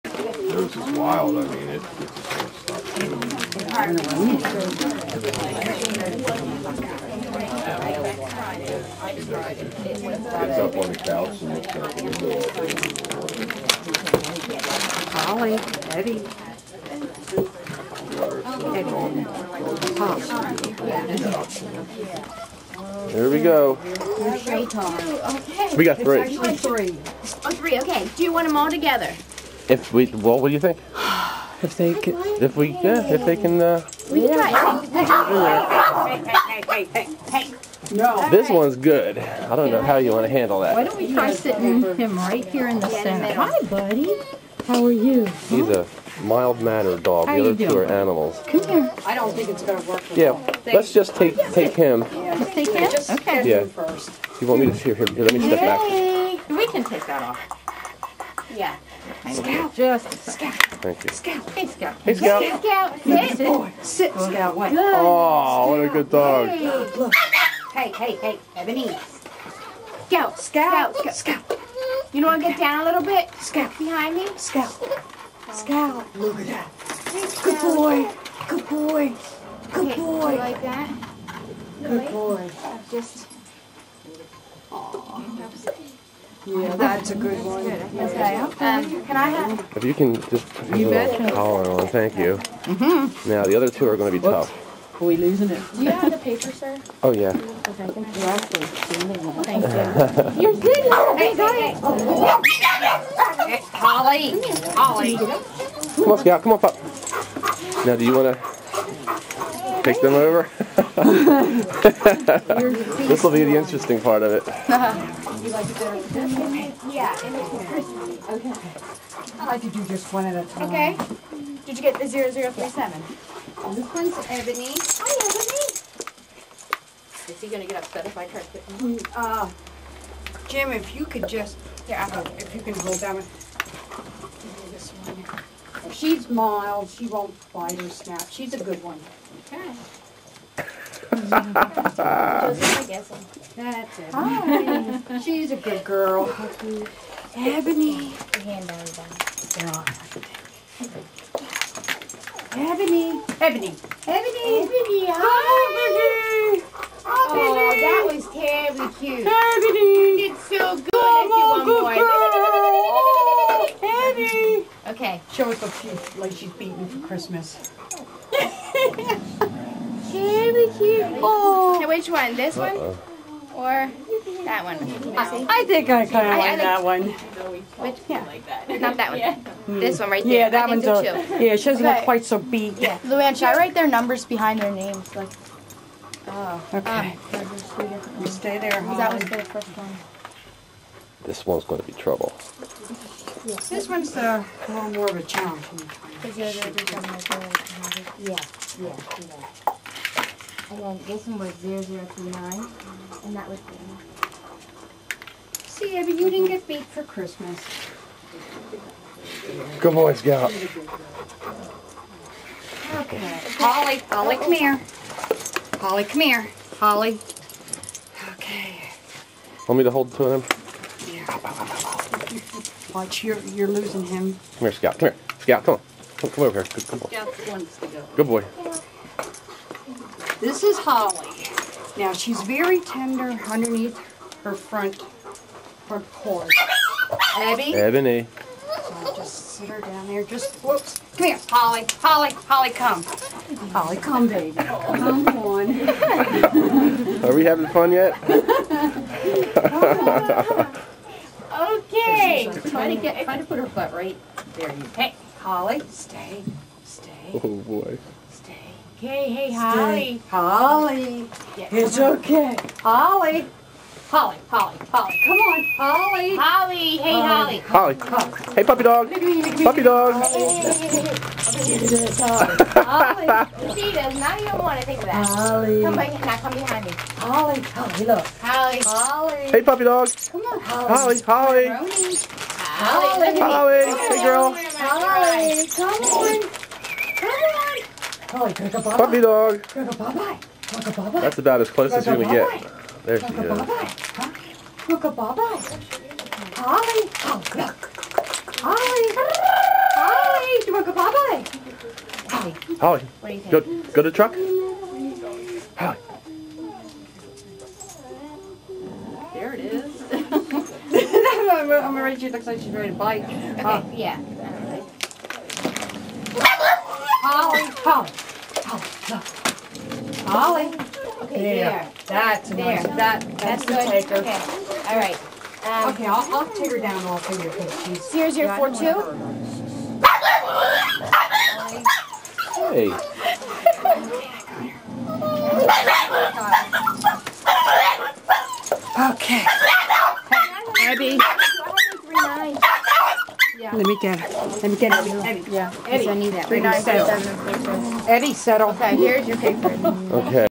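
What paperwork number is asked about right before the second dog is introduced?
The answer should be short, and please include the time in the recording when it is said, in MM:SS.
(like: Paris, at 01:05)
0037, at 02:02.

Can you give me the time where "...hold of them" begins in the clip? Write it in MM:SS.
03:39.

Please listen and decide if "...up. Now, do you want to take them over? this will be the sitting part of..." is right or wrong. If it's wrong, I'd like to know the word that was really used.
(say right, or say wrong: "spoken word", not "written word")
wrong: "interesting", not "sitting".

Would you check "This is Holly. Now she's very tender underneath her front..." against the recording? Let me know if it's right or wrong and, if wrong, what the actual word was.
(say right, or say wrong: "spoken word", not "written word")
right.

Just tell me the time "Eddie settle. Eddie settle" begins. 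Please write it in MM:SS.
05:46.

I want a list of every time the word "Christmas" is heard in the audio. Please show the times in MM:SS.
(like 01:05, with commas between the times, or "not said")
02:47, 03:27.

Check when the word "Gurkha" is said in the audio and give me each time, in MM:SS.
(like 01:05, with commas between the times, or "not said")
04:54, 05:00.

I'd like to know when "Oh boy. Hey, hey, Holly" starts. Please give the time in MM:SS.
04:17.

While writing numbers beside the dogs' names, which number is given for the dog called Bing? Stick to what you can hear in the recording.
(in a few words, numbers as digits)
0029.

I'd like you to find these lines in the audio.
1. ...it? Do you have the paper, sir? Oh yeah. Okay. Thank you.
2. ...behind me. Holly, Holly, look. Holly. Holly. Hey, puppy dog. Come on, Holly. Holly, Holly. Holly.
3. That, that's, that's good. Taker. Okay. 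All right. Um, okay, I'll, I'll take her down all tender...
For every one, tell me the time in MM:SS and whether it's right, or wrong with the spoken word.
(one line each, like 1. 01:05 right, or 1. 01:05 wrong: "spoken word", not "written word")
1. 01:35 right
2. 04:36 right
3. 05:22 wrong: "finger", not "tender".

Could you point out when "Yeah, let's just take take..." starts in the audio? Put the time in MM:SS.
00:50.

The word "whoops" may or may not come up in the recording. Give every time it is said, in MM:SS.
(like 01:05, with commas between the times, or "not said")
01:34, 04:00.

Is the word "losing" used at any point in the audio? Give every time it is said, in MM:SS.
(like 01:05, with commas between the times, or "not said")
01:35, 03:43.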